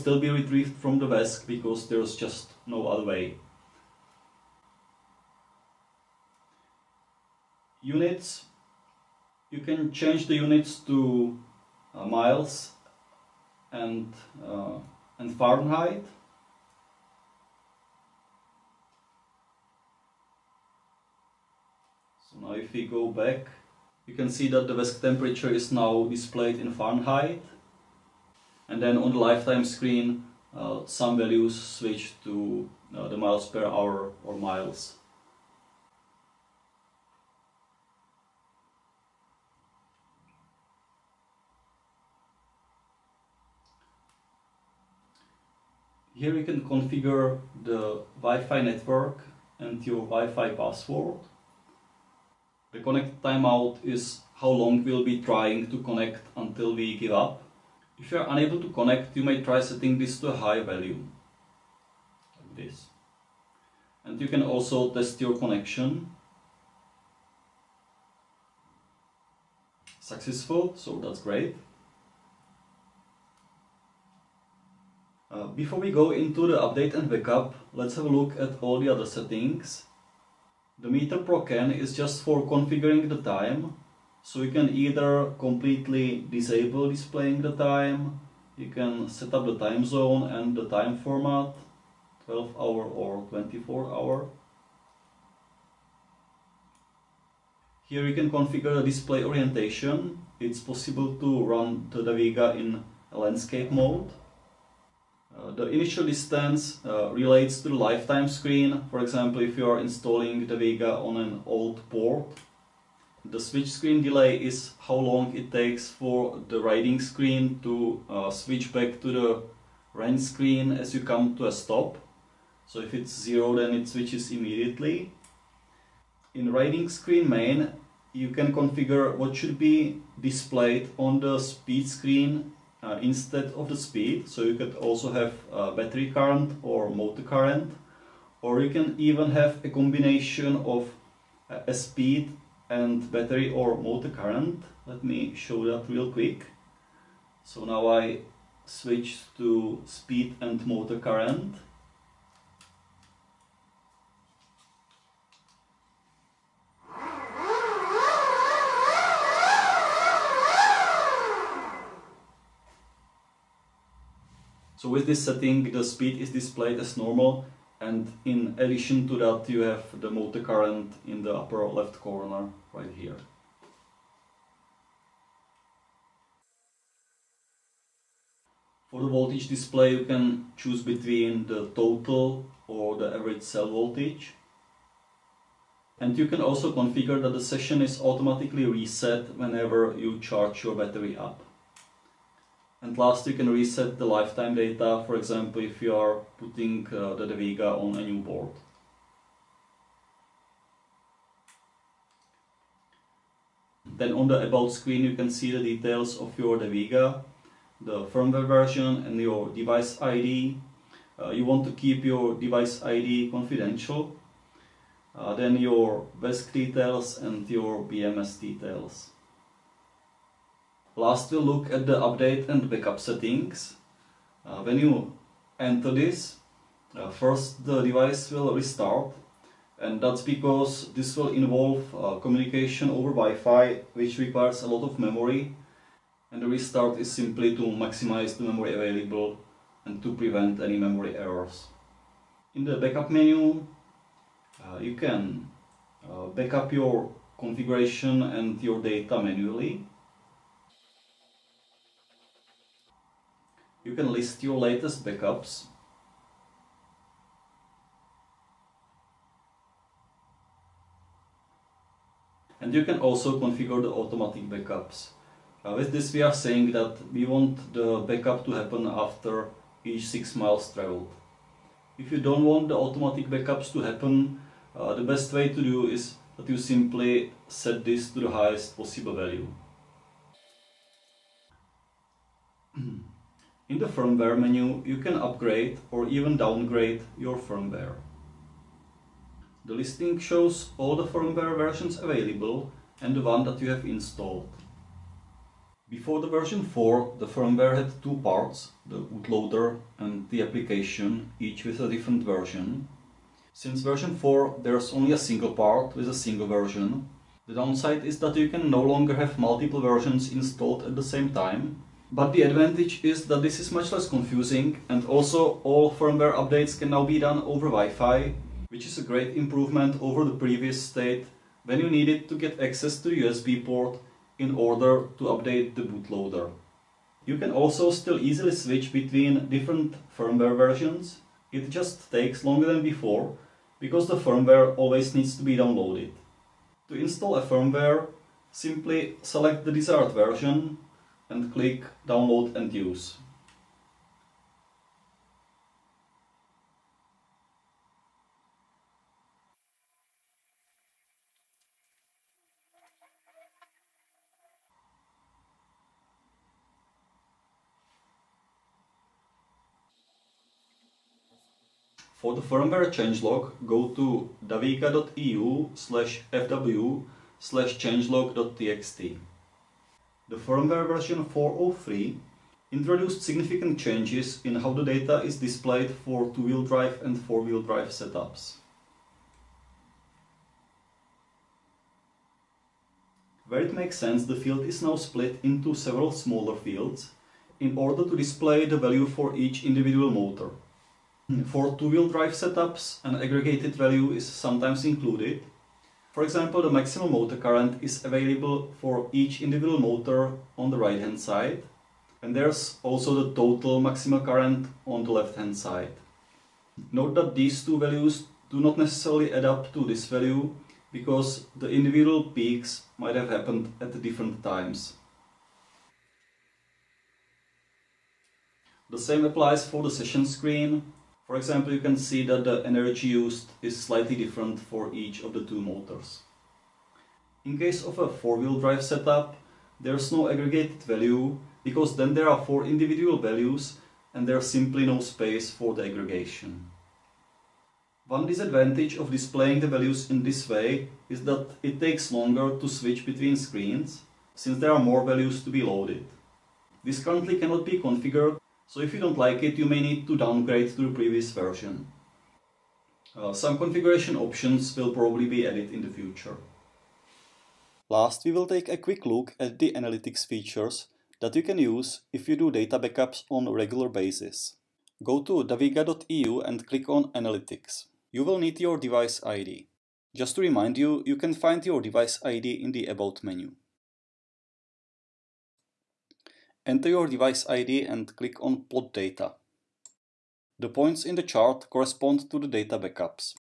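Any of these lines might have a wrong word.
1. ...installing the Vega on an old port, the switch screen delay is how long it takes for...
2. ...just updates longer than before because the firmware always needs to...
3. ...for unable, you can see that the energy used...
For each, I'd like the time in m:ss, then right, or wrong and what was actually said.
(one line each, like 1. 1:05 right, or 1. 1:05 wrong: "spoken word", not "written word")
1. 1:49 right
2. 5:31 wrong: "takes", not "updates"
3. 7:01 wrong: "example", not "unable".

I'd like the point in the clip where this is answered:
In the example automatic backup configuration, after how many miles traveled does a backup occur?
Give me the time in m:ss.
4:30.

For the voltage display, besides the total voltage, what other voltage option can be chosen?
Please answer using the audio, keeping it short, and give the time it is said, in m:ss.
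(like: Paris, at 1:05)
average cell voltage, at 3:03.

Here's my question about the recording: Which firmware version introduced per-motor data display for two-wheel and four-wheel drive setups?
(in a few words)
4.03.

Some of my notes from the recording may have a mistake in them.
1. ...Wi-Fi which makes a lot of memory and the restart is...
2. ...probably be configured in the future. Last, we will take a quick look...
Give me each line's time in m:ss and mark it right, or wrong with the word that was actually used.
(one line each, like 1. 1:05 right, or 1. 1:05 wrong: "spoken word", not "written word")
1. 3:53 wrong: "requires", not "makes"
2. 7:34 wrong: "added", not "configured".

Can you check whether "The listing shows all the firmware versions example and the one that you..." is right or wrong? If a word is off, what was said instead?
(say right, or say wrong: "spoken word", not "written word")
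wrong: "available", not "example".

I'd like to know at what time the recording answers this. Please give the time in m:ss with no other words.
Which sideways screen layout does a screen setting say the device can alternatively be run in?
1:43.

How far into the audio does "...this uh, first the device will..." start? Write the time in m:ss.
3:45.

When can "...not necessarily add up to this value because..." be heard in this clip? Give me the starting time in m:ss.
6:48.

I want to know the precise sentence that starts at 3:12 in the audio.
And last, you can reset the lifetime data, for example, if you are putting uh, the Vega on a new board.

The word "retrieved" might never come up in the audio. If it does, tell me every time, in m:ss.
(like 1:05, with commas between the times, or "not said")
0:00.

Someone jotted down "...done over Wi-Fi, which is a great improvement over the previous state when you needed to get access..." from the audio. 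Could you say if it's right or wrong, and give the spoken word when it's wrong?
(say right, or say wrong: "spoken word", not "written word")
right.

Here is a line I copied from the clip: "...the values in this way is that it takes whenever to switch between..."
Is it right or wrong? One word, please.
wrong.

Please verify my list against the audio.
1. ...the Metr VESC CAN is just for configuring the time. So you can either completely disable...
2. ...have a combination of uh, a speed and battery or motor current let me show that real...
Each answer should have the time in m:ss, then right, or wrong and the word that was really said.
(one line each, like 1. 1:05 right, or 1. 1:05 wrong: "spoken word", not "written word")
1. 1:20 wrong: "Pro", not "VESC"
2. 2:19 right.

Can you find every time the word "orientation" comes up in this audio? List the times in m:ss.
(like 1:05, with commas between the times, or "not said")
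1:39.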